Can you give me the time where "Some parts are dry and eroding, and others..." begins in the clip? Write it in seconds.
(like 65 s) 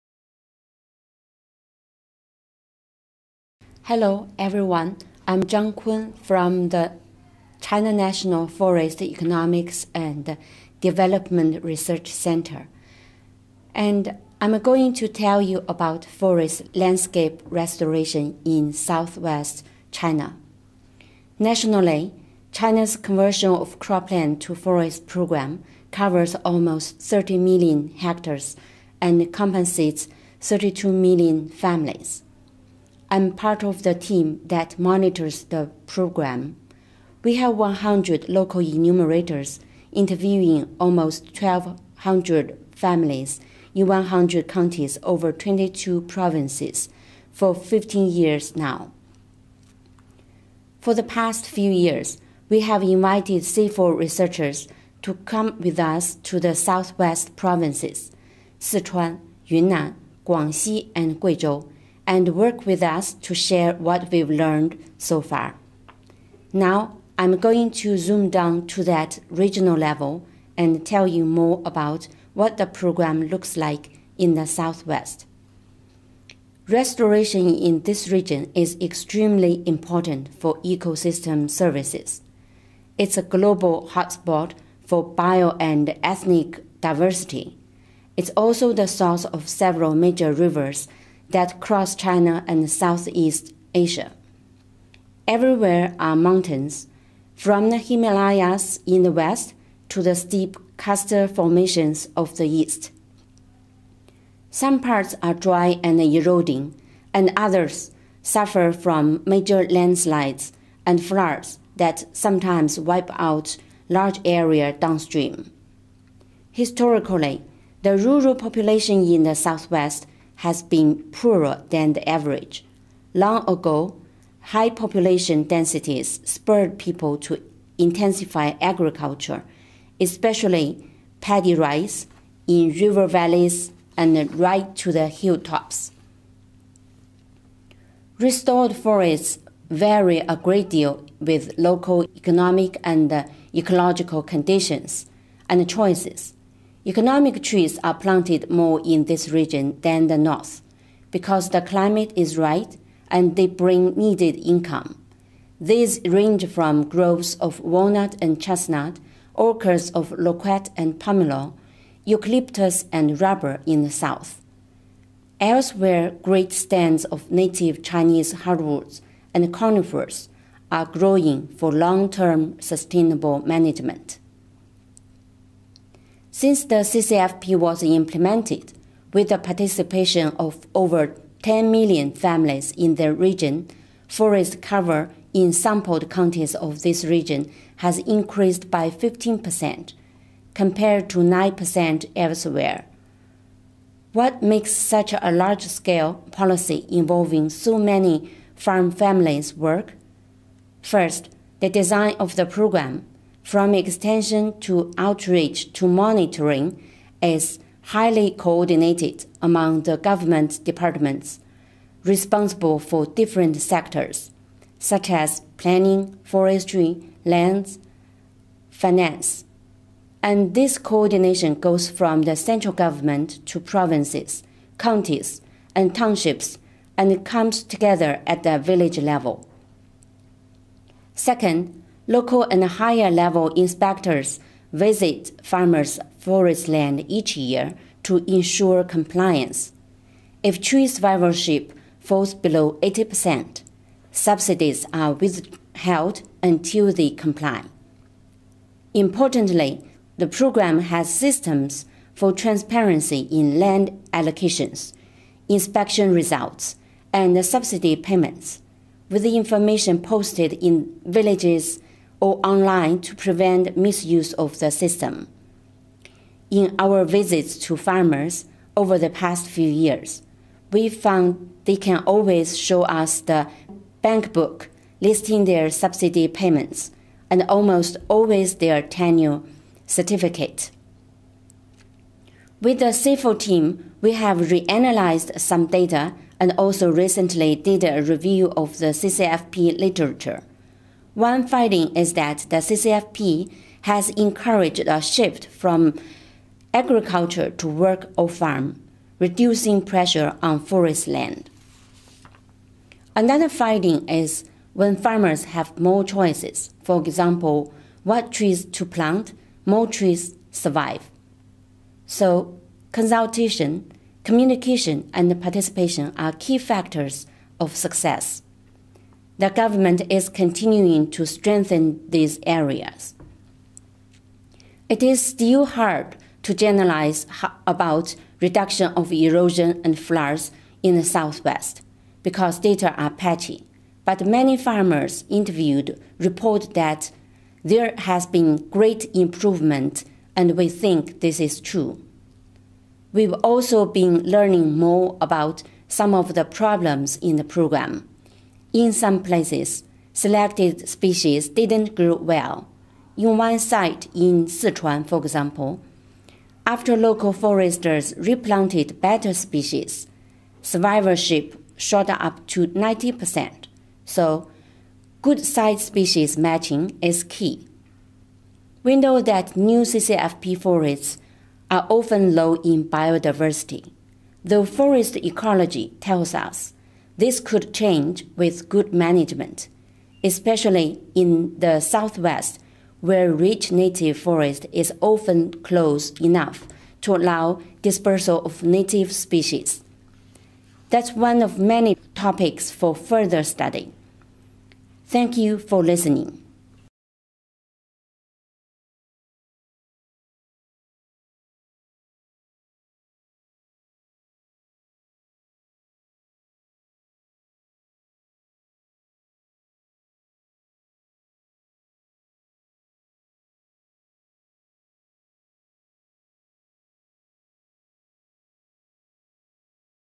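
104 s.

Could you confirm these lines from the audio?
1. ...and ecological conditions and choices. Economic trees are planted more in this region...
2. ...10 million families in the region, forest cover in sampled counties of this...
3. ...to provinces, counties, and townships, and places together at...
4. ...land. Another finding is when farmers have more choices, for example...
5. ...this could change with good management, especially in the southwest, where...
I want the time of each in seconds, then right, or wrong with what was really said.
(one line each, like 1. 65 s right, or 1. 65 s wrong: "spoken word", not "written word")
1. 142 s right
2. 181 s right
3. 223 s wrong: "comes", not "places"
4. 301 s right
5. 377 s right.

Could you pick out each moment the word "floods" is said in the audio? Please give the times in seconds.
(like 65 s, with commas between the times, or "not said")
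111 s, 329 s.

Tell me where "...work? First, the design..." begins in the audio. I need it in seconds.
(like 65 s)
199 s.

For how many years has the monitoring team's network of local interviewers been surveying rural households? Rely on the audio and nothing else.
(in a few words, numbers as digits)
15 years.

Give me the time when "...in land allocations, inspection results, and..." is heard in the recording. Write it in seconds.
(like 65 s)
253 s.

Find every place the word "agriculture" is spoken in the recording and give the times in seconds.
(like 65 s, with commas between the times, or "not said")
128 s, 296 s.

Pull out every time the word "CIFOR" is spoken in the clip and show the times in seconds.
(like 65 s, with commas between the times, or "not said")
53 s, 282 s.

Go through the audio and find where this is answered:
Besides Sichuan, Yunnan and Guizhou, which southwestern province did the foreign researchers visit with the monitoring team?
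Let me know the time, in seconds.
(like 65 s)
60 s.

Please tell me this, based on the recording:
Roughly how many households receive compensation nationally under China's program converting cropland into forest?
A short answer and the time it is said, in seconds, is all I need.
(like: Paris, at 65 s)
32 million, at 30 s.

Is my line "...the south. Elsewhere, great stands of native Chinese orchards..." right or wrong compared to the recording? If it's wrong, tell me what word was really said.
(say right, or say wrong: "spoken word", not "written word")
wrong: "hardwoods", not "orchards".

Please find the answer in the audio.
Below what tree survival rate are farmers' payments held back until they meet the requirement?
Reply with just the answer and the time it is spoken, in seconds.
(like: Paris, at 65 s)
80%, at 242 s.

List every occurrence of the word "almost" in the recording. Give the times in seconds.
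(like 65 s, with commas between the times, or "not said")
26 s, 40 s, 277 s.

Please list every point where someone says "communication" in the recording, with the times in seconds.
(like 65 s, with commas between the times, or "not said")
314 s.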